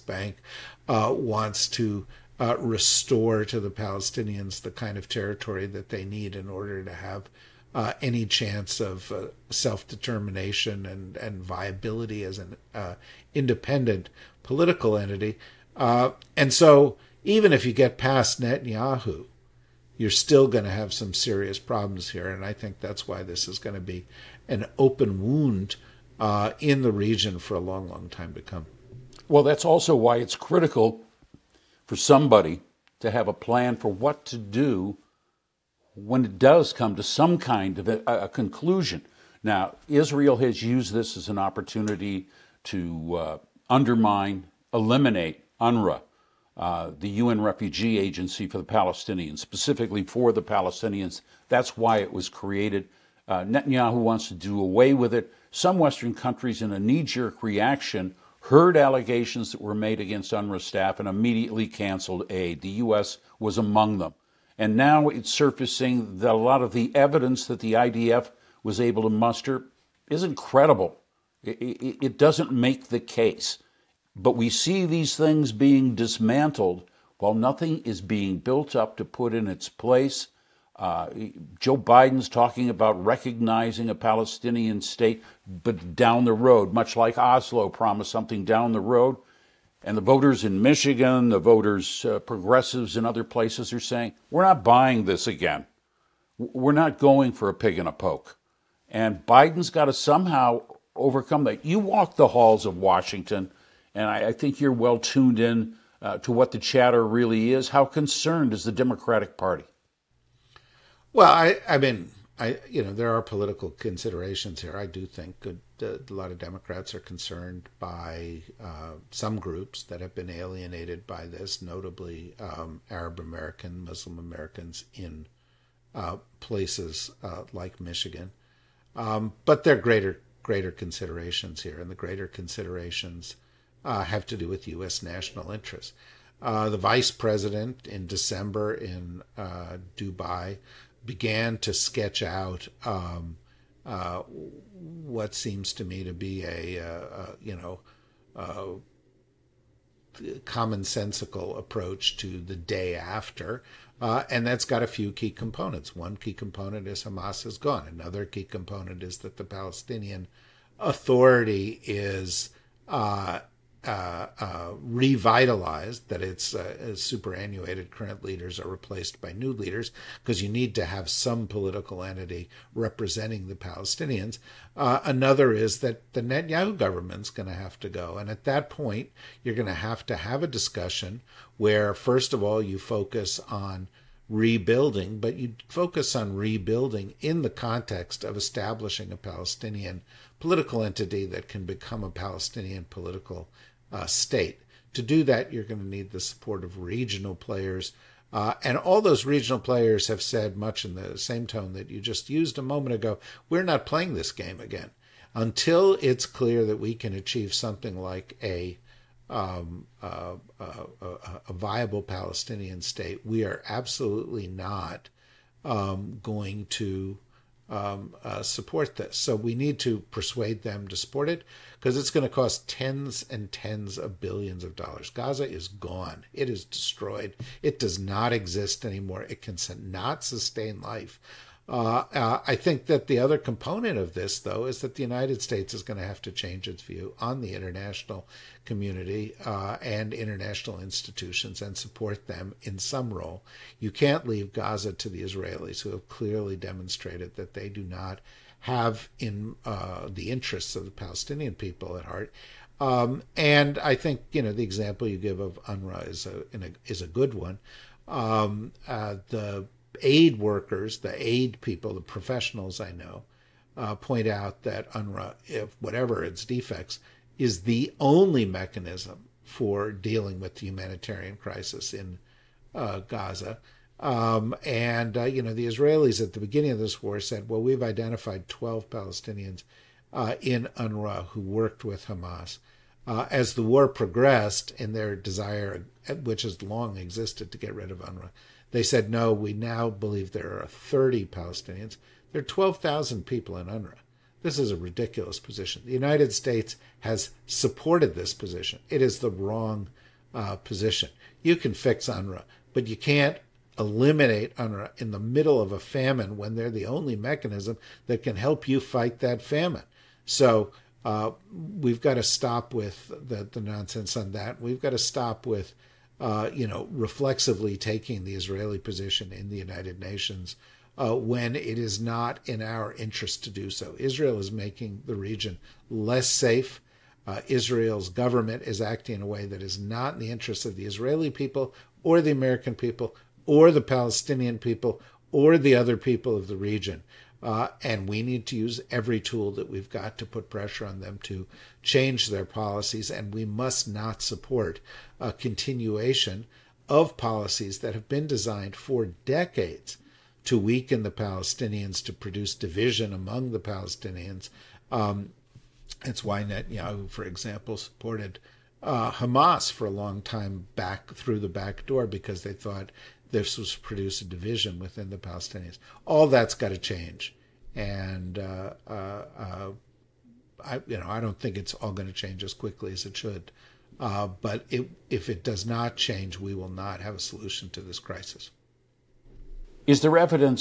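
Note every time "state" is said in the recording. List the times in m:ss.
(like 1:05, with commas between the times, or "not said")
1:24, 3:14, 3:32, 3:55, 4:56.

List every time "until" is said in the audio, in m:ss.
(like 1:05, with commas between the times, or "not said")
3:25.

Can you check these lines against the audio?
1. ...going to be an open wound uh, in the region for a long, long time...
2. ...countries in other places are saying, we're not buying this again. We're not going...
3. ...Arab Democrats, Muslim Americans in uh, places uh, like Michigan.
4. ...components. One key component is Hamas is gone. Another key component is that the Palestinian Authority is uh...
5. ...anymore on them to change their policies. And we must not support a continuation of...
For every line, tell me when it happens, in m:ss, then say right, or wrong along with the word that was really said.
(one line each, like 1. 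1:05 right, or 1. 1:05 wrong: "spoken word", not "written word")
1. 0:23 right
2. 1:32 wrong: "progressives", not "countries"
3. 2:02 wrong: "American", not "Democrats"
4. 2:35 right
5. 5:40 wrong: "pressure", not "anymore".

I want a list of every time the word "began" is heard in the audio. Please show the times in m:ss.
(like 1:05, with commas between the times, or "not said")
2:21.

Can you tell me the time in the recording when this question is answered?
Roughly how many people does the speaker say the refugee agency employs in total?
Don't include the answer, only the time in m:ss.
4:52.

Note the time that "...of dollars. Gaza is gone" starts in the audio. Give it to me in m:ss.
3:44.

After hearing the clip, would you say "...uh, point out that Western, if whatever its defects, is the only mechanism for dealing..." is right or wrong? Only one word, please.
wrong.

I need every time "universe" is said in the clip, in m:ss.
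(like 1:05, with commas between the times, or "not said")
not said.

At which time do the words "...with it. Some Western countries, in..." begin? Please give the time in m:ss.
0:54.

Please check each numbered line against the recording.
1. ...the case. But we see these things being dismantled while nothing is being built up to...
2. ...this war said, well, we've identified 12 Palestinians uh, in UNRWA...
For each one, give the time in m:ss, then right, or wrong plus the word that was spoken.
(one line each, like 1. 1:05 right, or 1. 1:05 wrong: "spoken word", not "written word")
1. 1:12 right
2. 4:36 right.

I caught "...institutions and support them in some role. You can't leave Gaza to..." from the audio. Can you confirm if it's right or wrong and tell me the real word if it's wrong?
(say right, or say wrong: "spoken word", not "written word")
right.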